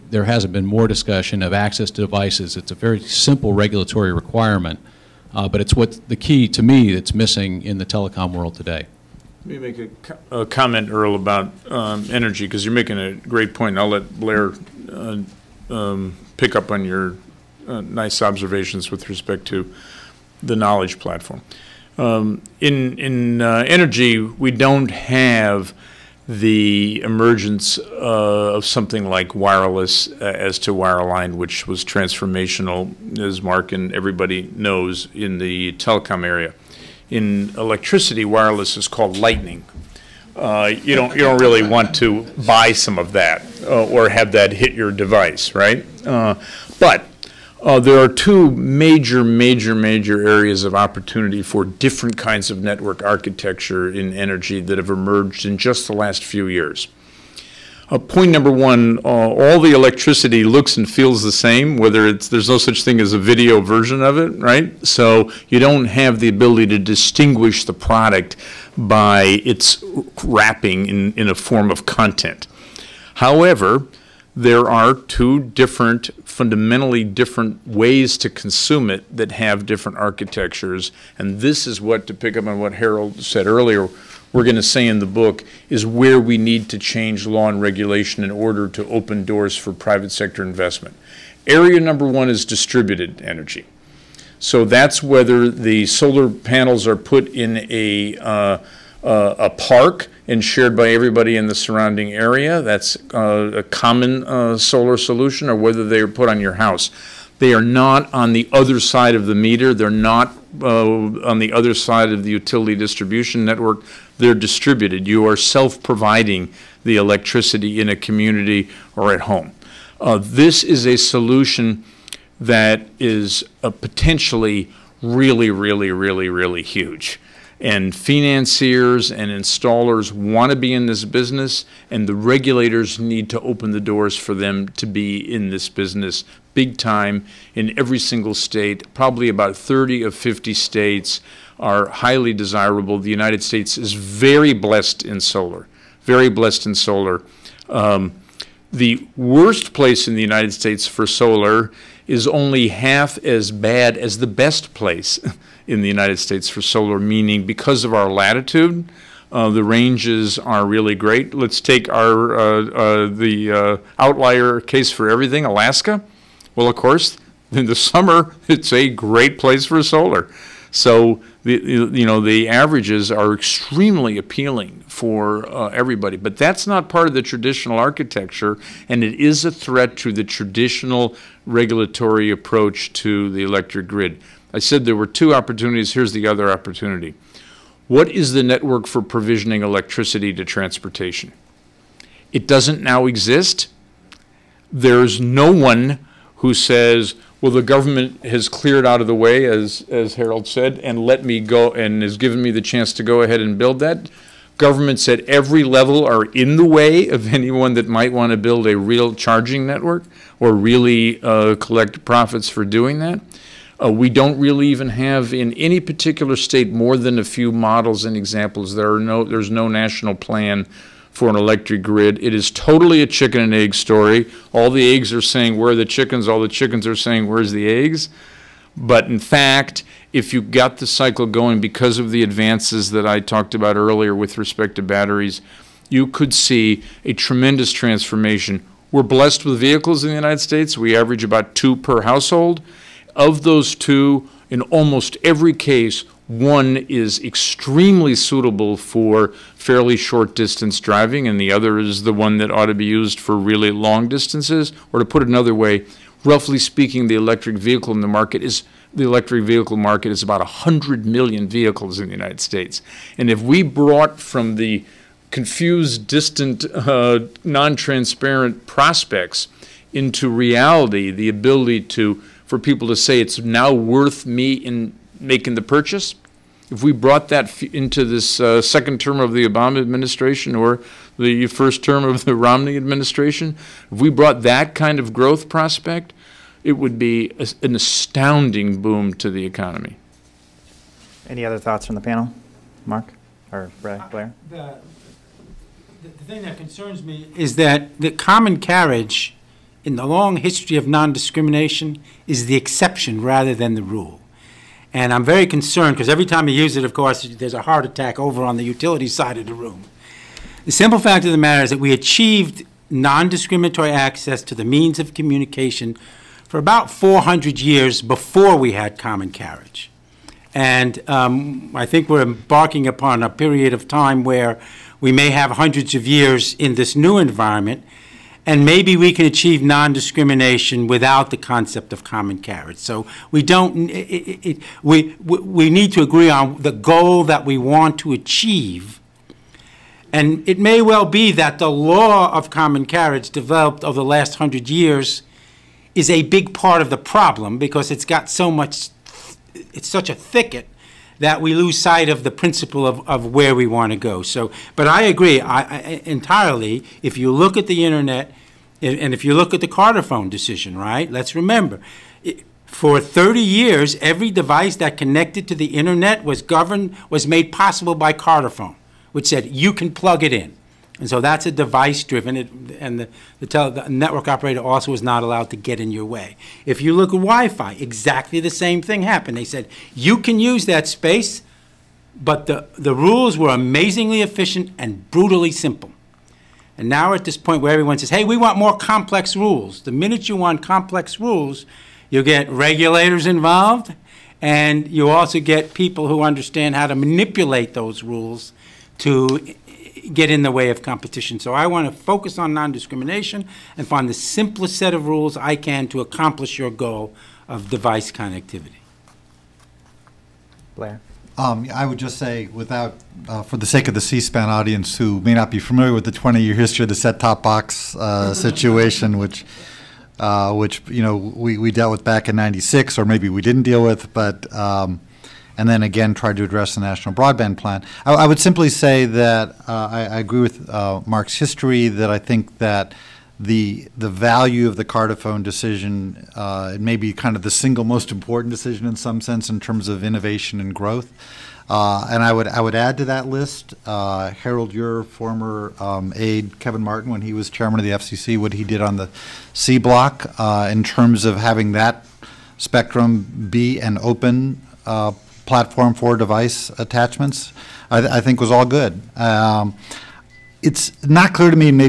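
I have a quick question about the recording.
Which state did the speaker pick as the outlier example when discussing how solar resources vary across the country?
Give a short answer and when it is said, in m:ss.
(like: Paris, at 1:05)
Alaska, at 2:45.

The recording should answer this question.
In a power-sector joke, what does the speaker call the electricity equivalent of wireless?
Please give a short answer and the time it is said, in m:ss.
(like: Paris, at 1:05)
Lightning, at 0:39.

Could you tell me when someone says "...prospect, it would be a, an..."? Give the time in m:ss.
4:45.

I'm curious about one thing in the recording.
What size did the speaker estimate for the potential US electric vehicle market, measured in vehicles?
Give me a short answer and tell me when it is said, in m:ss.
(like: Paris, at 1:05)
100 million, at 4:20.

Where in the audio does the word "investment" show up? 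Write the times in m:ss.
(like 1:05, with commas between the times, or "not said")
1:30.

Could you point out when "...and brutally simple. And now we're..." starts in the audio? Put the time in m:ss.
6:24.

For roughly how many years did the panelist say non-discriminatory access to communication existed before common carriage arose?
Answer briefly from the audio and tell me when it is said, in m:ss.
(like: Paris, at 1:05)
400, at 5:16.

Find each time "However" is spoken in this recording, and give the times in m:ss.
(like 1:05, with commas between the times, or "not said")
1:13.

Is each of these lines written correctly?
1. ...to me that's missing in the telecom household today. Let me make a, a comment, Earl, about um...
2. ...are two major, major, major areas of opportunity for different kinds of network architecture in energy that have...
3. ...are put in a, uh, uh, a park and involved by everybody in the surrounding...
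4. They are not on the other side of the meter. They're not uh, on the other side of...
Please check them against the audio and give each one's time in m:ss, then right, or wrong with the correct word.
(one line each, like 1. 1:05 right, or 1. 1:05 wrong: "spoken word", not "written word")
1. 0:06 wrong: "world", not "household"
2. 0:47 right
3. 1:36 wrong: "shared", not "involved"
4. 1:47 right.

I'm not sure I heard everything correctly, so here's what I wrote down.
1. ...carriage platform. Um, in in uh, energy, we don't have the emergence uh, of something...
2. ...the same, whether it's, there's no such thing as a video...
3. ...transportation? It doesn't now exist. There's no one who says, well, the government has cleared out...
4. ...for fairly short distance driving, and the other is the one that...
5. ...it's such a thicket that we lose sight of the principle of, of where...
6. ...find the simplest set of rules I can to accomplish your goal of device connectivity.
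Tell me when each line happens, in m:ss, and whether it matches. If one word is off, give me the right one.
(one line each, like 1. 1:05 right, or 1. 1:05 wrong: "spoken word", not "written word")
1. 0:20 wrong: "knowledge", not "carriage"
2. 1:01 right
3. 3:10 right
4. 4:08 right
5. 5:49 right
6. 6:43 right.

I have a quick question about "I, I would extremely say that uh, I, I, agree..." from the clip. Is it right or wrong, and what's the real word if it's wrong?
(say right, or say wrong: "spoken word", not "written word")
wrong: "simply", not "extremely".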